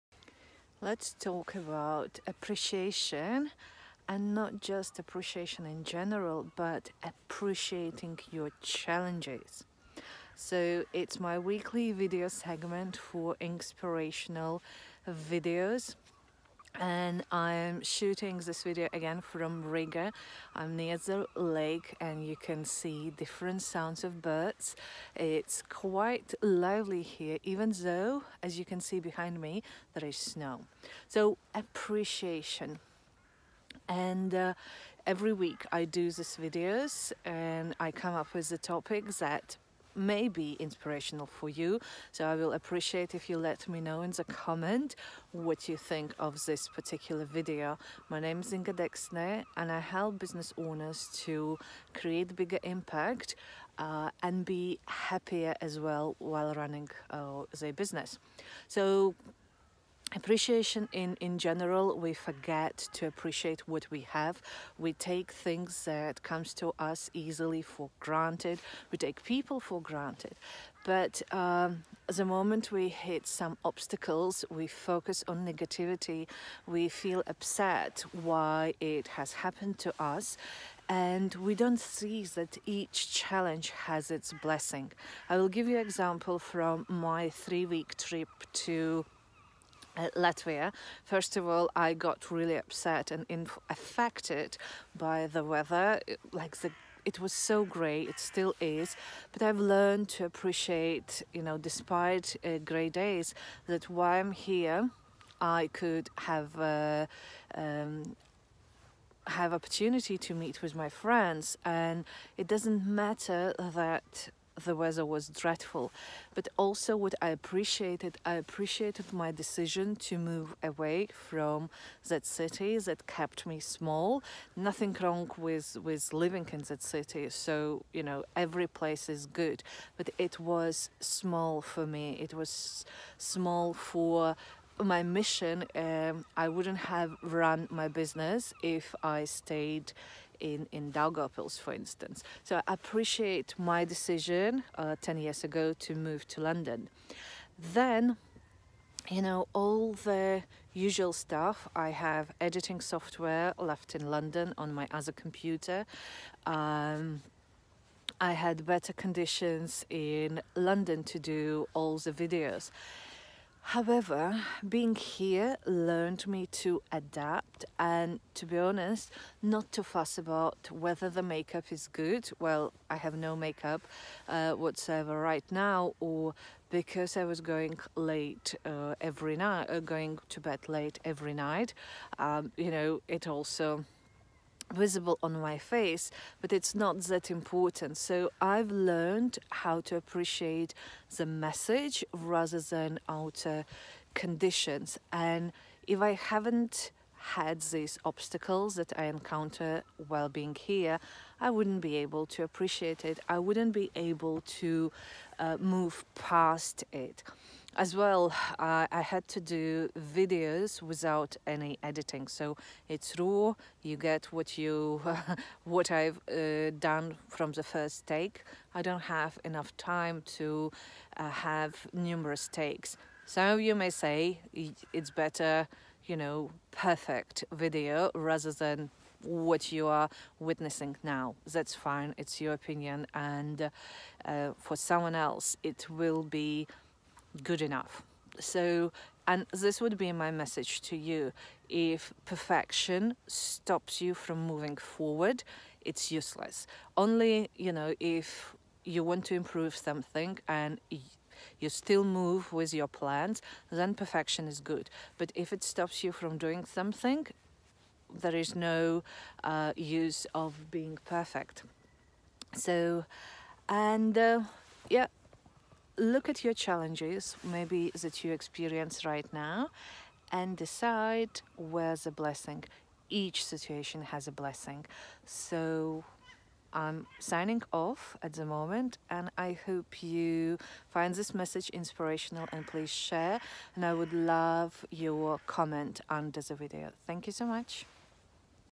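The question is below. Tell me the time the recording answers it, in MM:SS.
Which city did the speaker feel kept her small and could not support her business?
02:20.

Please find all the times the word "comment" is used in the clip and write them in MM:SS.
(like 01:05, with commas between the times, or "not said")
00:44, 04:45.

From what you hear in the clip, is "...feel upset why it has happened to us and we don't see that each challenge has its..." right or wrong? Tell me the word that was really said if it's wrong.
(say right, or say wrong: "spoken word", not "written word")
right.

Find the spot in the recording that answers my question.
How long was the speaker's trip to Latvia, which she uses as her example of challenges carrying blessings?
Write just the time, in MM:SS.
01:27.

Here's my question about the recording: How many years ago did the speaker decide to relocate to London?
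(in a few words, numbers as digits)
10.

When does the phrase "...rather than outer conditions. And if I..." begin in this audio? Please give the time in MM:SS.
03:12.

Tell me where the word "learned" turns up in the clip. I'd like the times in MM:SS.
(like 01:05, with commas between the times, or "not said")
01:39, 02:45, 03:08.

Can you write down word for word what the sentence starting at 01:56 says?
But also what I appreciated, I appreciated my decision to move away from that city that kept me small.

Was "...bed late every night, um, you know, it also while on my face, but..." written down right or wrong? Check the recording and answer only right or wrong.
wrong.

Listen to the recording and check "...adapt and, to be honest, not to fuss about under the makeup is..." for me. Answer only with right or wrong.
wrong.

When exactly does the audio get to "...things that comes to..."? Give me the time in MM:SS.
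01:05.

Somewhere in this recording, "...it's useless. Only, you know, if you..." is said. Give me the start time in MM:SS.
04:05.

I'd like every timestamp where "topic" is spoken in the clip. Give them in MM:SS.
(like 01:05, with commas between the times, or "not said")
00:38.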